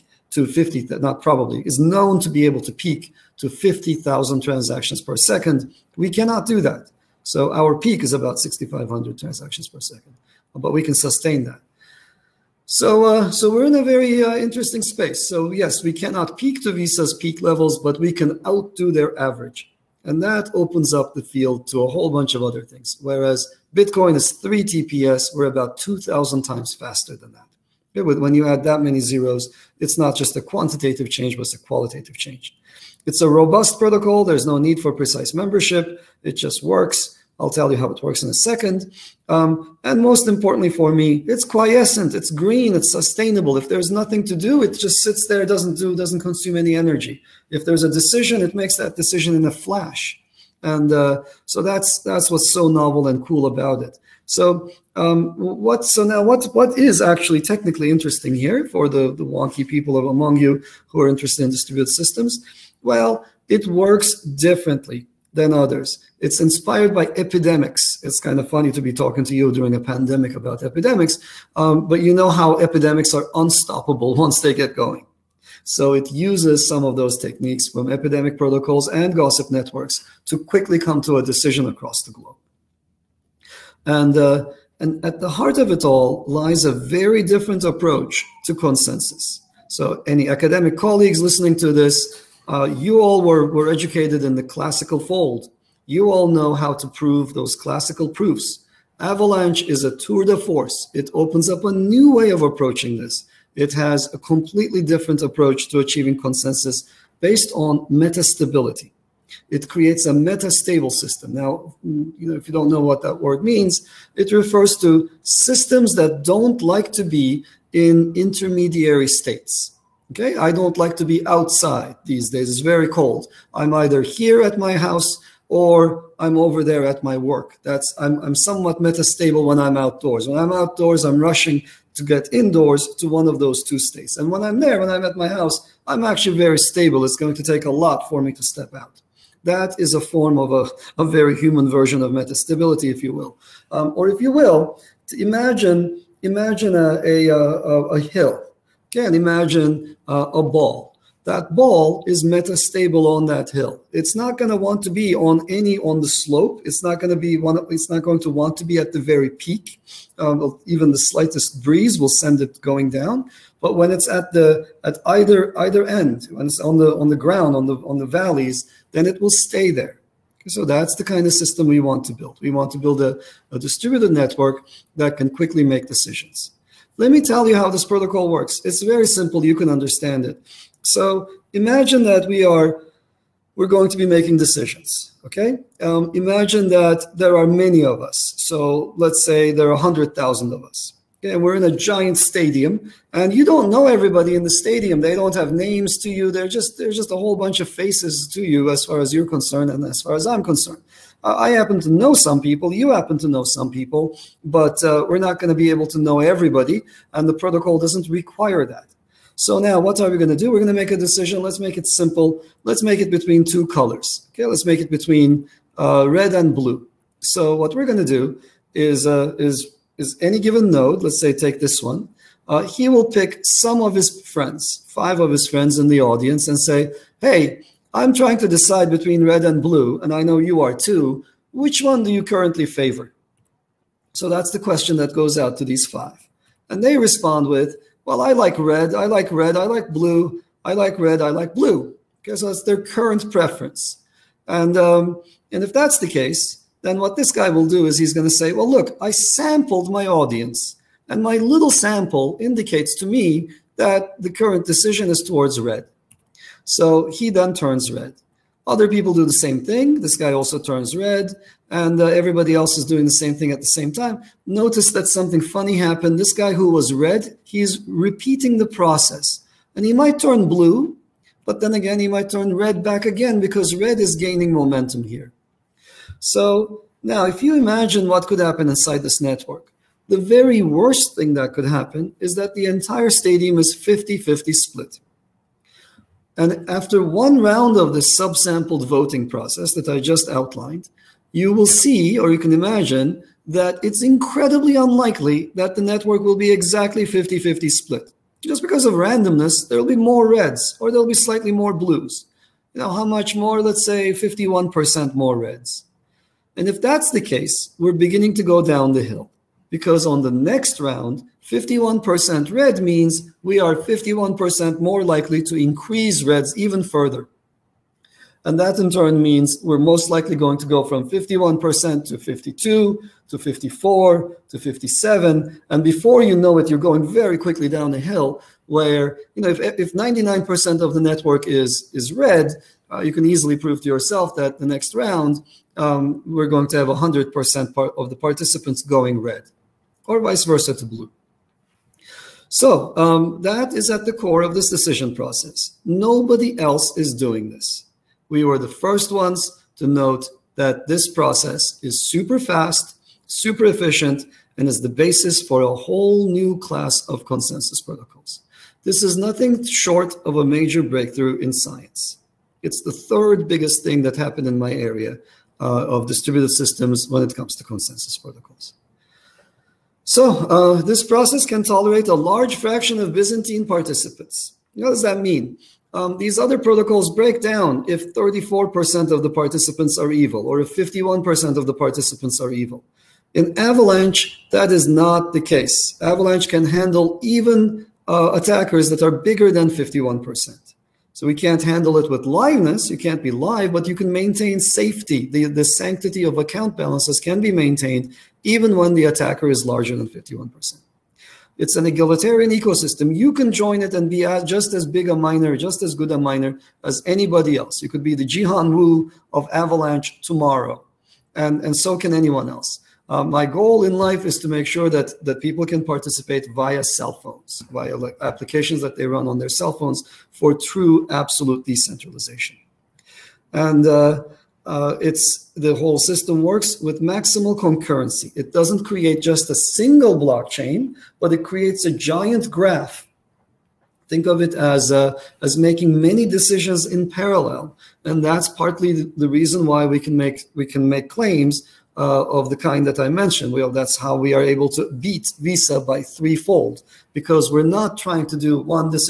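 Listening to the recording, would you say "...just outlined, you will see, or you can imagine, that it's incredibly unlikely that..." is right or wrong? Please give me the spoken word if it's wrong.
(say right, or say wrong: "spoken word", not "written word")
right.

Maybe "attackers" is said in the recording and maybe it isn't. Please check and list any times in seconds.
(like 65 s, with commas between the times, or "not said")
388 s, 399 s.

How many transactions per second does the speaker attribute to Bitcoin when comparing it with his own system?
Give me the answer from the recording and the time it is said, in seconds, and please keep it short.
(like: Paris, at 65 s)
3, at 24 s.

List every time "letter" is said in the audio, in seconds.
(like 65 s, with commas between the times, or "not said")
not said.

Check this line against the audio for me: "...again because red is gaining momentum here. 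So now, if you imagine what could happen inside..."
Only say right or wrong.
right.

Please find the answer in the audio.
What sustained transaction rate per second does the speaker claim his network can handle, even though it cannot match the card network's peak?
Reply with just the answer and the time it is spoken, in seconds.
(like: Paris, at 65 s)
6,500, at 8 s.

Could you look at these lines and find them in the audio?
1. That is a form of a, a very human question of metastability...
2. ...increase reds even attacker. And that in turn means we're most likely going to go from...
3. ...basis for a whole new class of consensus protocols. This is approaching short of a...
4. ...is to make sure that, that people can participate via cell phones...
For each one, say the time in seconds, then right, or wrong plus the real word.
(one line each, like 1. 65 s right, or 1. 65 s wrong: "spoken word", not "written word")
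1. 139 s wrong: "version", not "question"
2. 315 s wrong: "further", not "attacker"
3. 354 s wrong: "nothing", not "approaching"
4. 414 s right.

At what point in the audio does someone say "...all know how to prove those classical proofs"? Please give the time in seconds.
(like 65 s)
96 s.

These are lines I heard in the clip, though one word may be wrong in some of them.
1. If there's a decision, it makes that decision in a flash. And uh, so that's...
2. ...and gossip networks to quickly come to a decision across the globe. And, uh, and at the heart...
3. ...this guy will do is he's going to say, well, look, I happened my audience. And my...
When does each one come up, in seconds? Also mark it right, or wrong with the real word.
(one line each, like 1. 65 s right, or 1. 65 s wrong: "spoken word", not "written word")
1. 47 s right
2. 78 s right
3. 247 s wrong: "sampled", not "happened".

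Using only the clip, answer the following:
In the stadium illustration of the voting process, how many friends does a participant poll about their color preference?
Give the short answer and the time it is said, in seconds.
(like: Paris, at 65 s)
5, at 224 s.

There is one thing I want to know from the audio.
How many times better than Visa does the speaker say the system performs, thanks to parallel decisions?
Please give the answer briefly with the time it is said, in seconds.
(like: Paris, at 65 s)
threefold, at 446 s.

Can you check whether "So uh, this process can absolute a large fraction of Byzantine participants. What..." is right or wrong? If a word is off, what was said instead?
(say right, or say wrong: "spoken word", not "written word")
wrong: "tolerate", not "absolute".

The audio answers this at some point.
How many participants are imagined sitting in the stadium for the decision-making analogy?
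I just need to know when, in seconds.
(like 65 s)
189 s.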